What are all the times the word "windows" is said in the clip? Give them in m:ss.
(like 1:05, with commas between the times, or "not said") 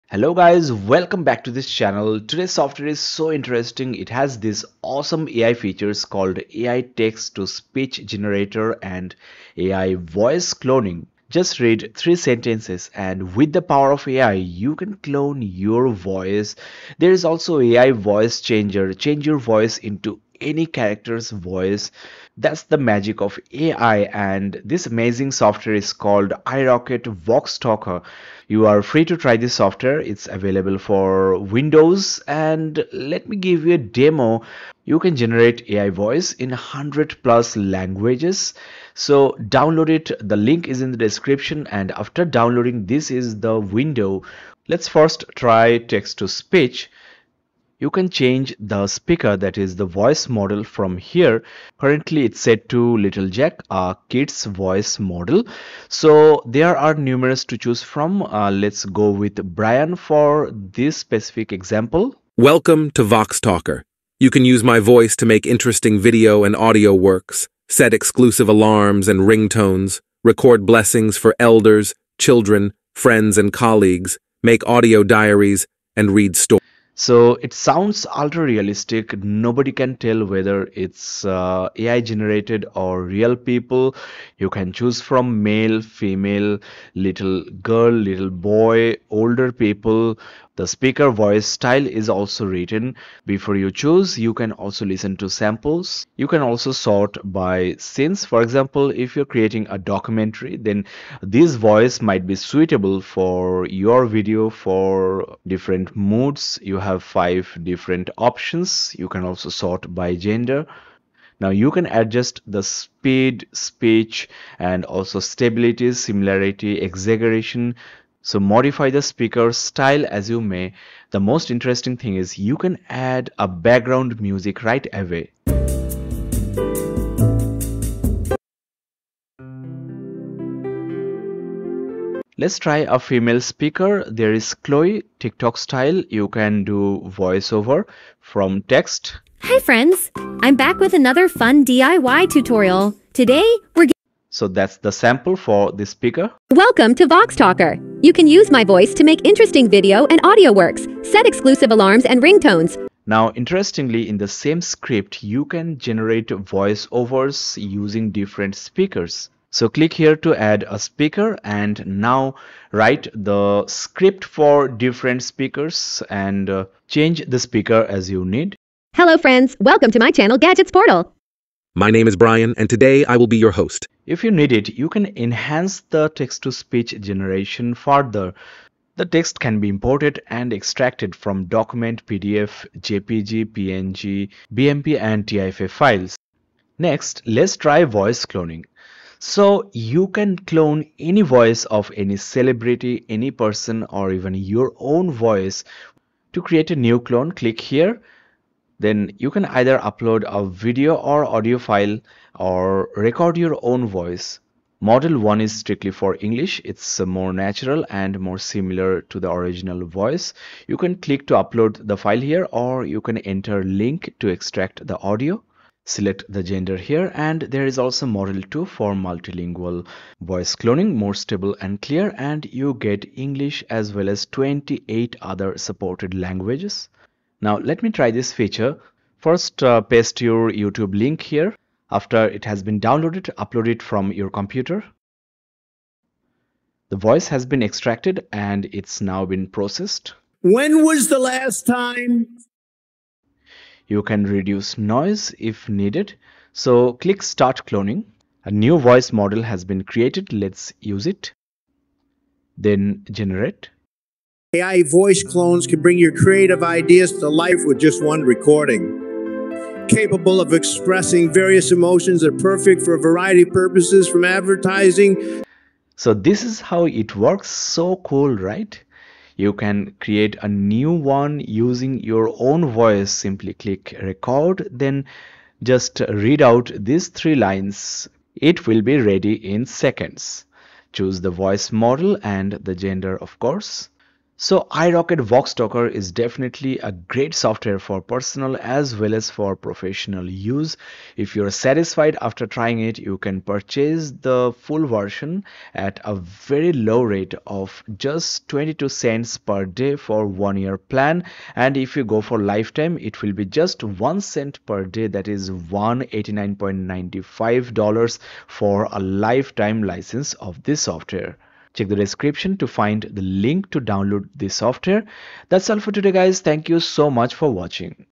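0:31, 0:43.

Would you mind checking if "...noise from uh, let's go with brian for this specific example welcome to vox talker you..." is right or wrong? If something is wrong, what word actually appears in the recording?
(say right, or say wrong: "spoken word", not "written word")
wrong: "choose", not "noise".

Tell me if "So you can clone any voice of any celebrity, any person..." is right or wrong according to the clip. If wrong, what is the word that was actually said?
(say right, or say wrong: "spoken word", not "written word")
right.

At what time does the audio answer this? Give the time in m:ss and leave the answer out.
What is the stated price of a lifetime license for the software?
5:05.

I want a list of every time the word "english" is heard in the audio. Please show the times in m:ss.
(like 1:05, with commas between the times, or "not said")
3:26, 3:43.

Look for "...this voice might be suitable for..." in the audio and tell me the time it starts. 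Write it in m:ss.
1:41.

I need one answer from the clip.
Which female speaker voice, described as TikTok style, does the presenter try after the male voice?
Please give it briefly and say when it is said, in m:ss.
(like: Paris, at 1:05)
Chloe, at 2:14.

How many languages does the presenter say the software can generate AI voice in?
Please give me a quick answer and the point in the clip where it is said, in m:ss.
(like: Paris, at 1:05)
100 plus, at 0:36.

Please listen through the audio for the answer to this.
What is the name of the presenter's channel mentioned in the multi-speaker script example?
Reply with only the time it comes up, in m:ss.
2:50.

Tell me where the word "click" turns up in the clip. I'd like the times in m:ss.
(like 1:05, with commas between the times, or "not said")
2:39, 3:17, 3:30, 4:06, 4:33.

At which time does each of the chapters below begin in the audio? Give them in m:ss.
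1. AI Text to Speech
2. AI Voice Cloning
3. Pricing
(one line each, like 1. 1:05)
1. 0:44
2. 3:06
3. 4:51.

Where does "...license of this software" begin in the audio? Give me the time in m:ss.
5:09.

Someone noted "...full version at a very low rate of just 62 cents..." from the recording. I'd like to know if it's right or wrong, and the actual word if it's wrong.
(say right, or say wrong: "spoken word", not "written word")
wrong: "22", not "62".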